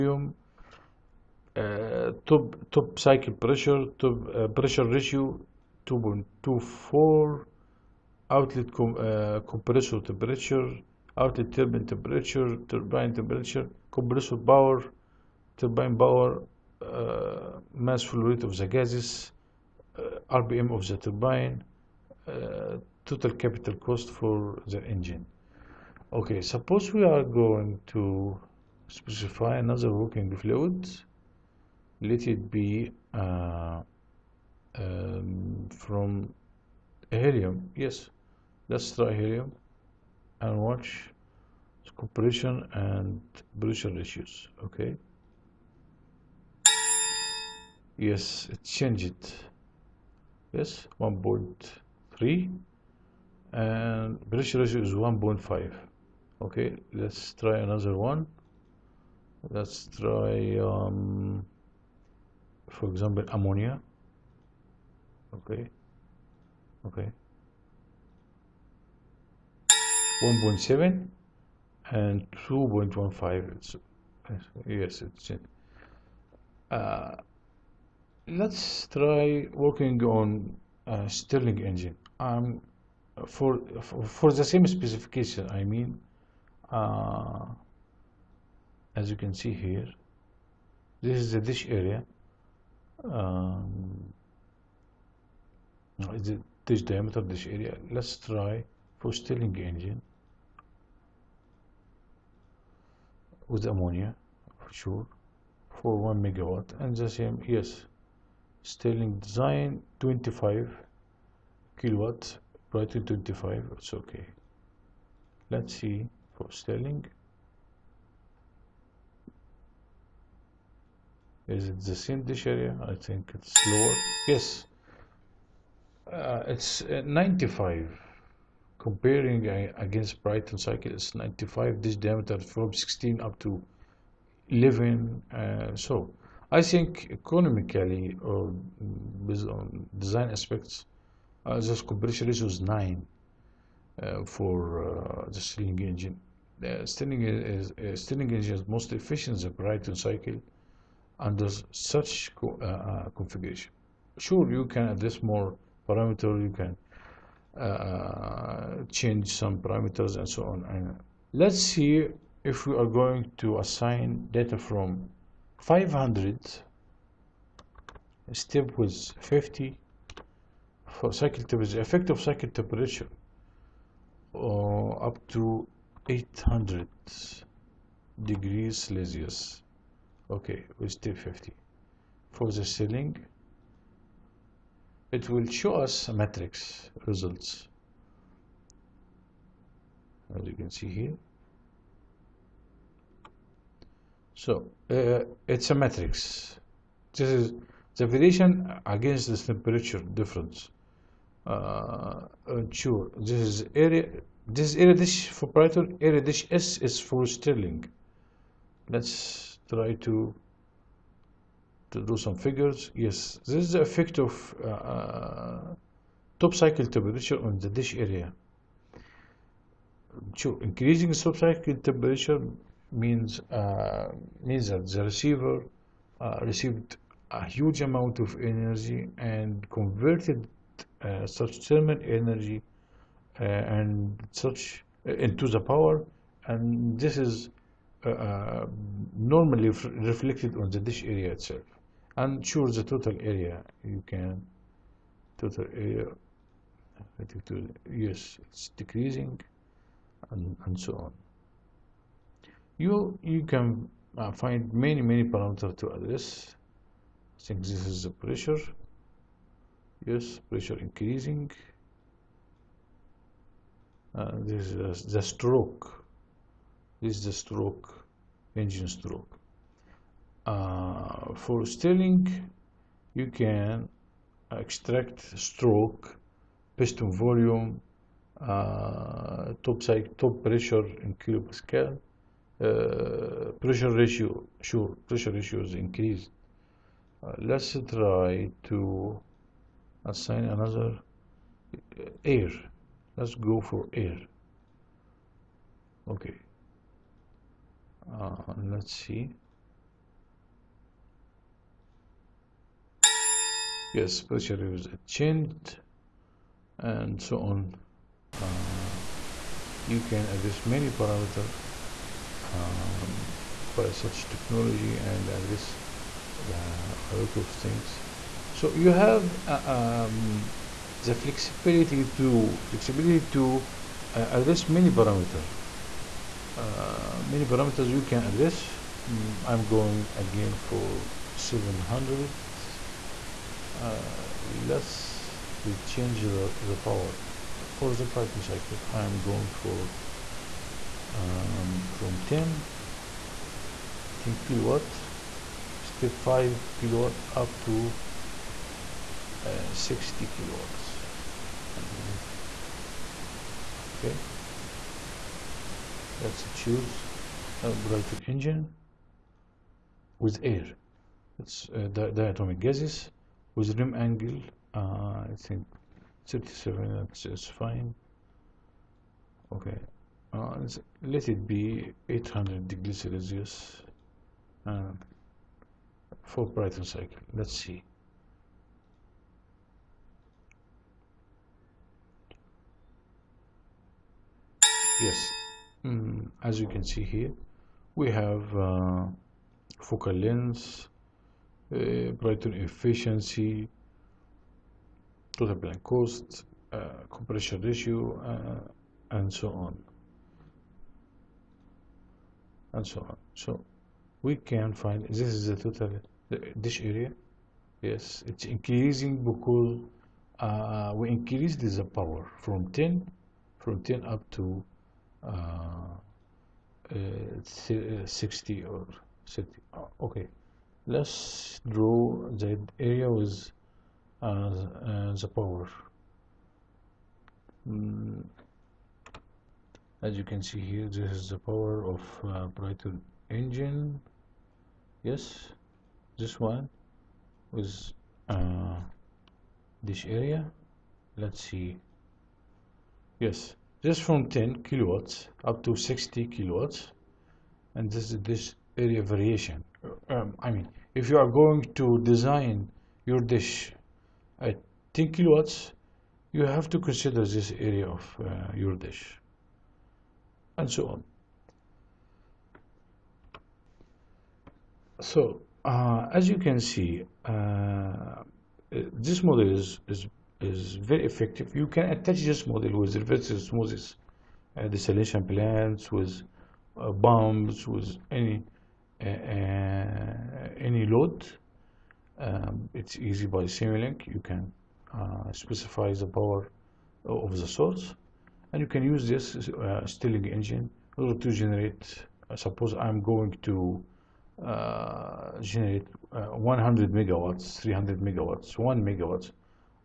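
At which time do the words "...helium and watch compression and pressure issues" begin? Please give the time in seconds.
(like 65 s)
39 s.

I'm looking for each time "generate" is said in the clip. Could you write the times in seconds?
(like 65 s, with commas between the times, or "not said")
491 s, 495 s.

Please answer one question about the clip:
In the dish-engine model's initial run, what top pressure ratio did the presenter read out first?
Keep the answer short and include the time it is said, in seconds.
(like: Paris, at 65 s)
2.24, at 4 s.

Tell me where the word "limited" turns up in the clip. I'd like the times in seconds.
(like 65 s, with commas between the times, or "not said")
not said.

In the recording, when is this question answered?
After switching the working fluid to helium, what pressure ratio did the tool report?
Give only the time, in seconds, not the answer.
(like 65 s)
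54 s.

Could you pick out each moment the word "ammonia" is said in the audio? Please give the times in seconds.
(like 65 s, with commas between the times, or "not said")
63 s, 103 s.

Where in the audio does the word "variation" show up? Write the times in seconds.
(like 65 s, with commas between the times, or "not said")
198 s, 449 s.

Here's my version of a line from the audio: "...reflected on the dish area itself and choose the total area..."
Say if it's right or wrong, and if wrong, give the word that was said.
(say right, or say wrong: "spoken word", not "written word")
right.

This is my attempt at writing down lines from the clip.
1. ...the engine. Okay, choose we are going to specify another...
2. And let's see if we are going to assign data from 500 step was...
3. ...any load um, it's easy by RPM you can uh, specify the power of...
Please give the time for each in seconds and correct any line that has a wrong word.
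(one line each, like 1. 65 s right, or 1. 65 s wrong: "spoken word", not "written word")
1. 24 s wrong: "suppose", not "choose"
2. 160 s right
3. 478 s wrong: "Simulink", not "RPM".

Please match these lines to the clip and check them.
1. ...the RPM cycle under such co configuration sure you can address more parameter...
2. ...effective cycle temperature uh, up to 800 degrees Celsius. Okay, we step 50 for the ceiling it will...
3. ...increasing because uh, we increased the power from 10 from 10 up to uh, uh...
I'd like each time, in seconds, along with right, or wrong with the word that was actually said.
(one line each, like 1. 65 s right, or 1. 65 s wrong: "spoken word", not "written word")
1. 149 s wrong: "Brayton", not "RPM"
2. 171 s right
3. 408 s right.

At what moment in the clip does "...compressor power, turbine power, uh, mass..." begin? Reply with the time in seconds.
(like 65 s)
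13 s.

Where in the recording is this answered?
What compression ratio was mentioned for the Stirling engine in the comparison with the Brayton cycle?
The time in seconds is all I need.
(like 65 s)
141 s.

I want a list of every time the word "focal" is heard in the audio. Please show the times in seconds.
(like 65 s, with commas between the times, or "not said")
389 s.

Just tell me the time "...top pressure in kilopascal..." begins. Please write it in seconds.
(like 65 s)
280 s.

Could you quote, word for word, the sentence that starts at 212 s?
Yes, this is the effect of uh, uh top cycle temperature on the dish area.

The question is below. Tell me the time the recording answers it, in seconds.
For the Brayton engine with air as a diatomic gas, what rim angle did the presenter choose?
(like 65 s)
366 s.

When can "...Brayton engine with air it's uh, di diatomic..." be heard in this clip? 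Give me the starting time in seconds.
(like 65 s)
357 s.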